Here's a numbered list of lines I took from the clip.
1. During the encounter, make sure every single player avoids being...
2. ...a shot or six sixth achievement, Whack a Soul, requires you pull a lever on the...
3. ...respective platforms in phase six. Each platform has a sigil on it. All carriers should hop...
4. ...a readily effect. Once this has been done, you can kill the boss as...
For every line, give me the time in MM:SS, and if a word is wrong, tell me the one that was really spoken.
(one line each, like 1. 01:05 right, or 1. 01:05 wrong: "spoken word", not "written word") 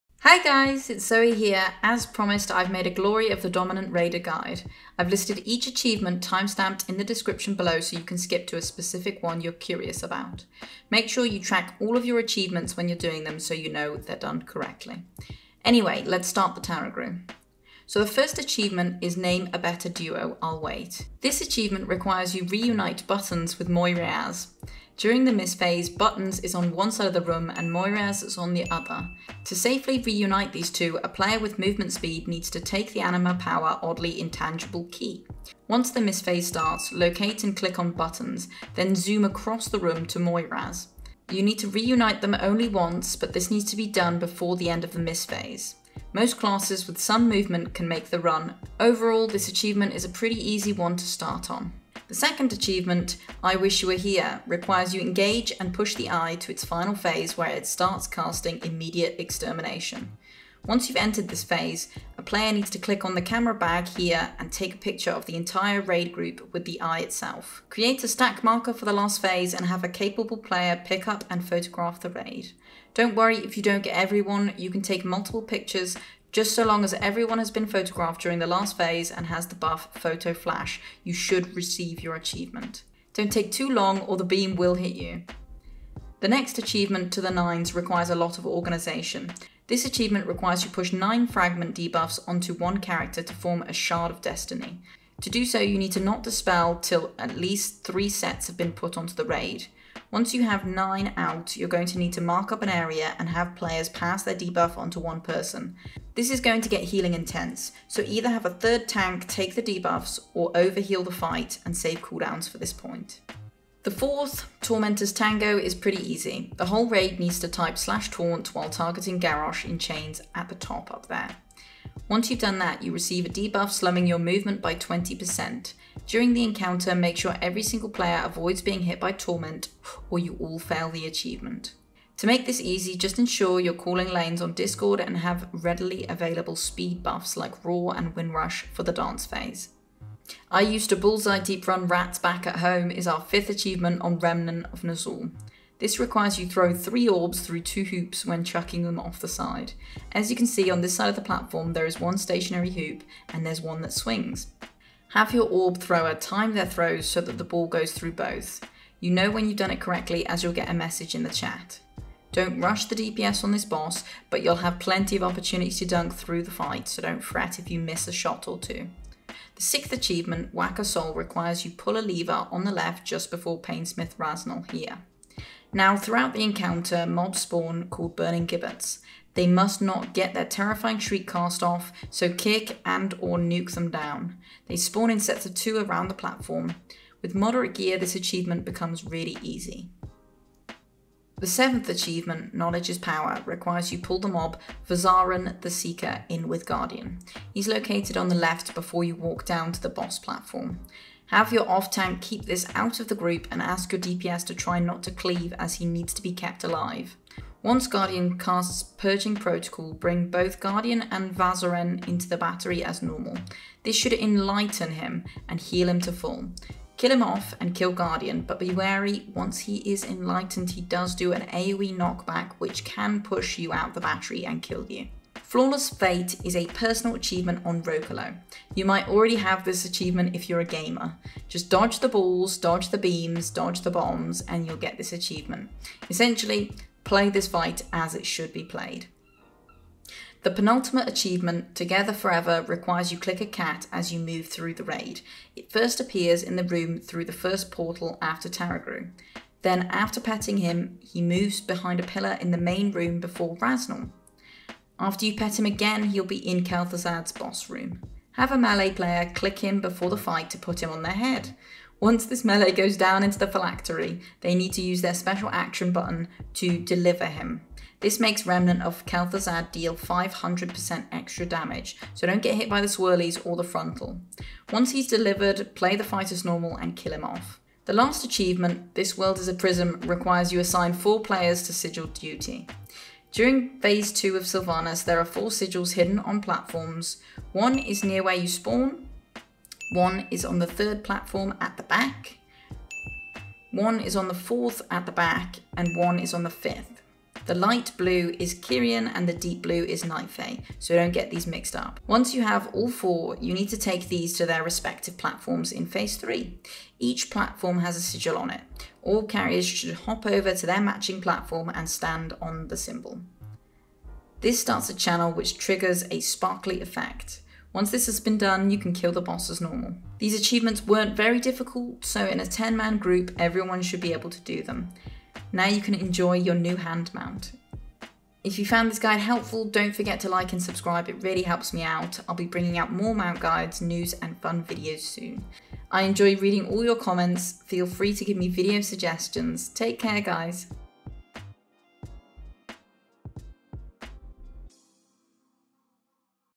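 1. 02:06 right
2. 02:48 wrong: "two", not "six"
3. 05:04 wrong: "three", not "six"
4. 05:16 wrong: "sparkly", not "readily".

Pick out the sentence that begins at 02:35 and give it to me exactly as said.
Have your orb thrower time their throws so that the ball goes through both.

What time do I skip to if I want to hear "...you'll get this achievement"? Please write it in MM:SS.
03:54.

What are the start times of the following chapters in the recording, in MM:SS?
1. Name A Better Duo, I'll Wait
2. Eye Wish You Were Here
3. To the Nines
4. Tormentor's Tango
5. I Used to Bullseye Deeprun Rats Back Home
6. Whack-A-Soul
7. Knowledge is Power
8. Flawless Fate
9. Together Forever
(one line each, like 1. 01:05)
1. 00:17
2. 00:51
3. 01:26
4. 01:54
5. 02:19
6. 02:49
7. 03:10
8. 03:45
9. 03:59.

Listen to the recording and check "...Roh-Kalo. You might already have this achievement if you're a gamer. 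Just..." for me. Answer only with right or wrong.
right.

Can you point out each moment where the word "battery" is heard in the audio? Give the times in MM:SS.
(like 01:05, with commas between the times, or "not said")
03:32, 03:43.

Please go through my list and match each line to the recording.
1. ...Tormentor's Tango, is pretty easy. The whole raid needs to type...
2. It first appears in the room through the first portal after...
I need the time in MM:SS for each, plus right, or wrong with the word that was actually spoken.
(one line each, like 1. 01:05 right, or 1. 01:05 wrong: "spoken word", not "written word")
1. 01:54 right
2. 04:05 right.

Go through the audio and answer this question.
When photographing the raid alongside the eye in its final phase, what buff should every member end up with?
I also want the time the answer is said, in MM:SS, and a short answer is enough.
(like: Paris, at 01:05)
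Photo Flash, at 01:19.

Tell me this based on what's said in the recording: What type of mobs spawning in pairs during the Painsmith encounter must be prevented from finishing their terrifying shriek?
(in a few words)
Burning Gibbets.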